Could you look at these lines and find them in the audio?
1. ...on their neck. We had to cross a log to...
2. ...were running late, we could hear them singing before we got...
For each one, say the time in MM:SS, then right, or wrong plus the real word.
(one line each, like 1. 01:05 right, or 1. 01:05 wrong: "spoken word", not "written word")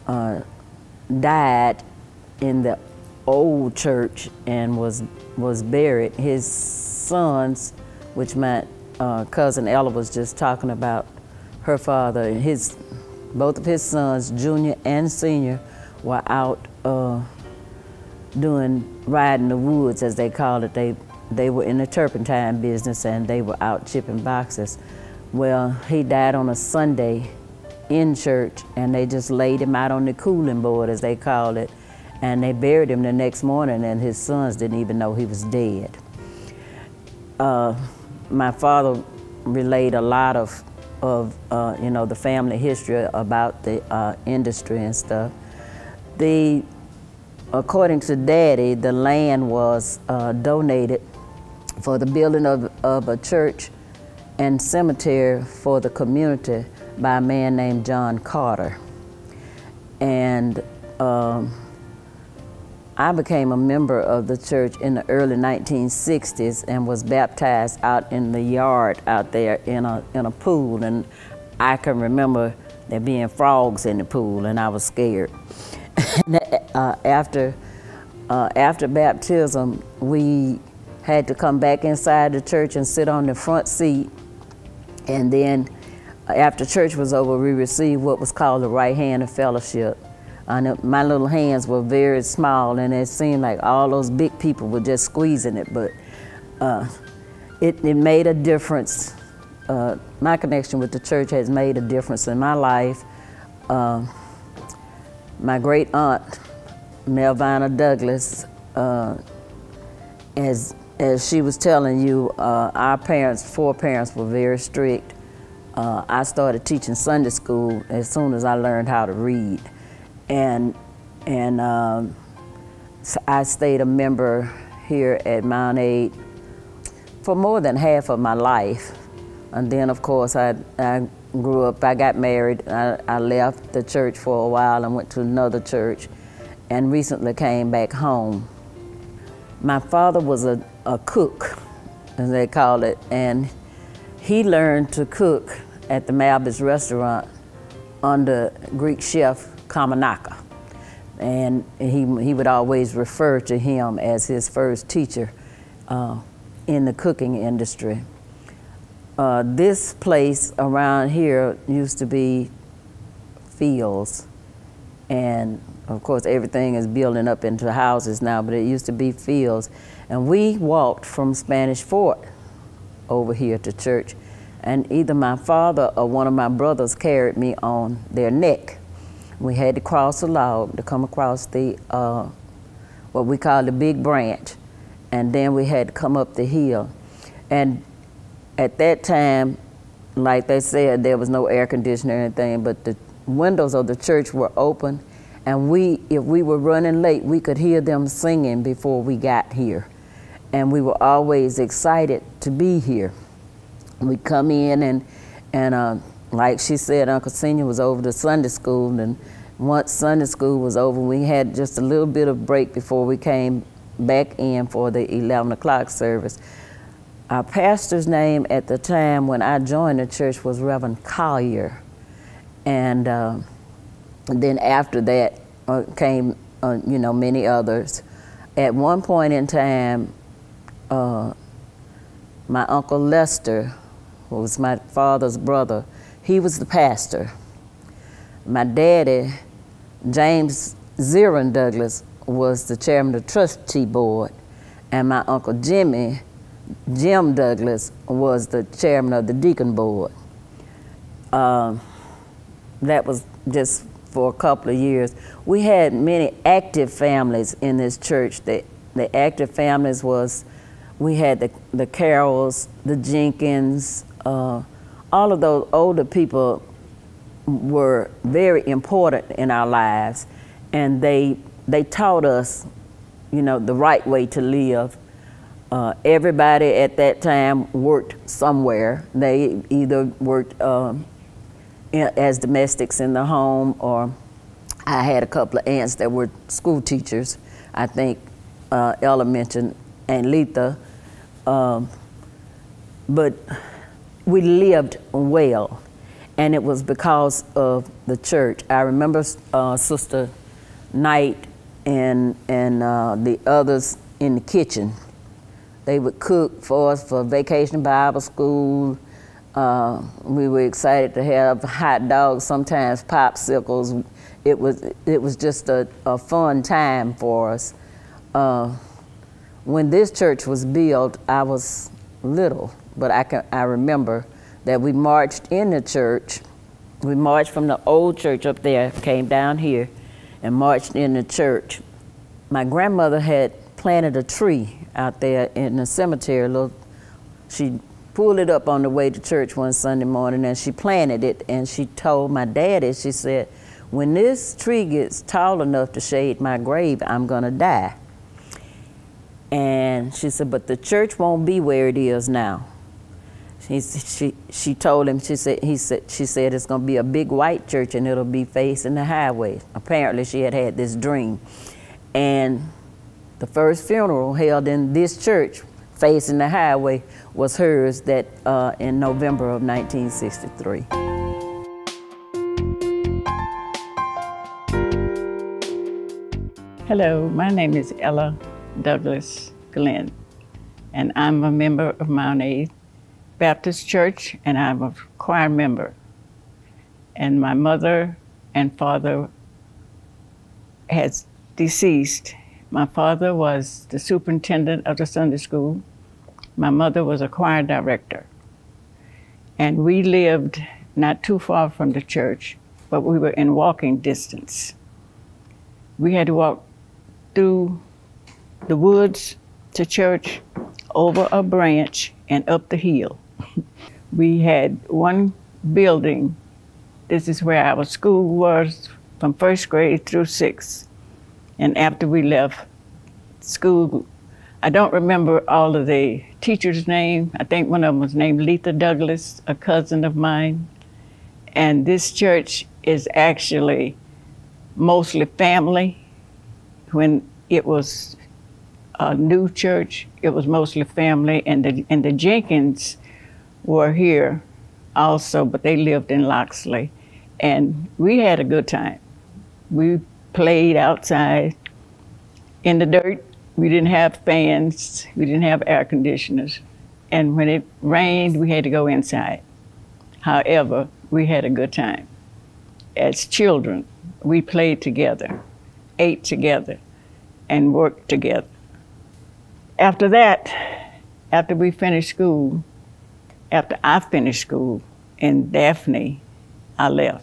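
1. 02:57 right
2. 03:16 right.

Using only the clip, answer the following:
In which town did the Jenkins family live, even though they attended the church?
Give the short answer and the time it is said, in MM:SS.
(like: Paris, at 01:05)
Loxley, at 07:26.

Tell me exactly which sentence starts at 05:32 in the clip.
My grandmother had planted a tree out there in the cemetery.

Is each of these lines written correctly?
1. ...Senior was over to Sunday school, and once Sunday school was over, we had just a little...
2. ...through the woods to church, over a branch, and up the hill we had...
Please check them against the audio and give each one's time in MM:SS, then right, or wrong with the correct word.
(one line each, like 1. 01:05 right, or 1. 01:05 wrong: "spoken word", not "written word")
1. 03:27 right
2. 06:47 right.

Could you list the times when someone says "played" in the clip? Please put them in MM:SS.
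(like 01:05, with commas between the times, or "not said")
07:30, 07:44.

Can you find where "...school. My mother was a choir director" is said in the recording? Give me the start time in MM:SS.
06:35.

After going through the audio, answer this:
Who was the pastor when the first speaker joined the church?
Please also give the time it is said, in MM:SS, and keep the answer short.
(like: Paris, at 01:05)
Reverend Collier, at 03:40.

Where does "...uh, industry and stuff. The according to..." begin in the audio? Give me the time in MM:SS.
00:43.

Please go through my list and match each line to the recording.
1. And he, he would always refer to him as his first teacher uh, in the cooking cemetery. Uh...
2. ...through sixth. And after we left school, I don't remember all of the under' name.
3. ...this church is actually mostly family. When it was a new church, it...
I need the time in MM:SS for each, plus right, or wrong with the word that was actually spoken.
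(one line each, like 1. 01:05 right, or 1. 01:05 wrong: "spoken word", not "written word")
1. 02:31 wrong: "industry", not "cemetery"
2. 07:00 wrong: "teachers", not "under"
3. 07:11 right.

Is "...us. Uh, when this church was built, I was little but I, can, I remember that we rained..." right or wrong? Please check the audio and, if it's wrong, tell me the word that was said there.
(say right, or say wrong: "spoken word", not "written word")
wrong: "marched", not "rained".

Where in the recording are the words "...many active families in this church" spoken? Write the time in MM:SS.
04:15.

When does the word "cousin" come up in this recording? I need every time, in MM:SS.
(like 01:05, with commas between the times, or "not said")
00:09, 07:09.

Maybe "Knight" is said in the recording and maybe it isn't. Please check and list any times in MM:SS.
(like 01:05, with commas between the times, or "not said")
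05:00.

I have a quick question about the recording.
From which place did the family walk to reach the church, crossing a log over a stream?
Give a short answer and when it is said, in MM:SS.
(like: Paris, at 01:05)
Spanish Fort, at 02:51.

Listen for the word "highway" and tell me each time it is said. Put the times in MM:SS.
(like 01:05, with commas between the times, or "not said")
05:59, 06:06.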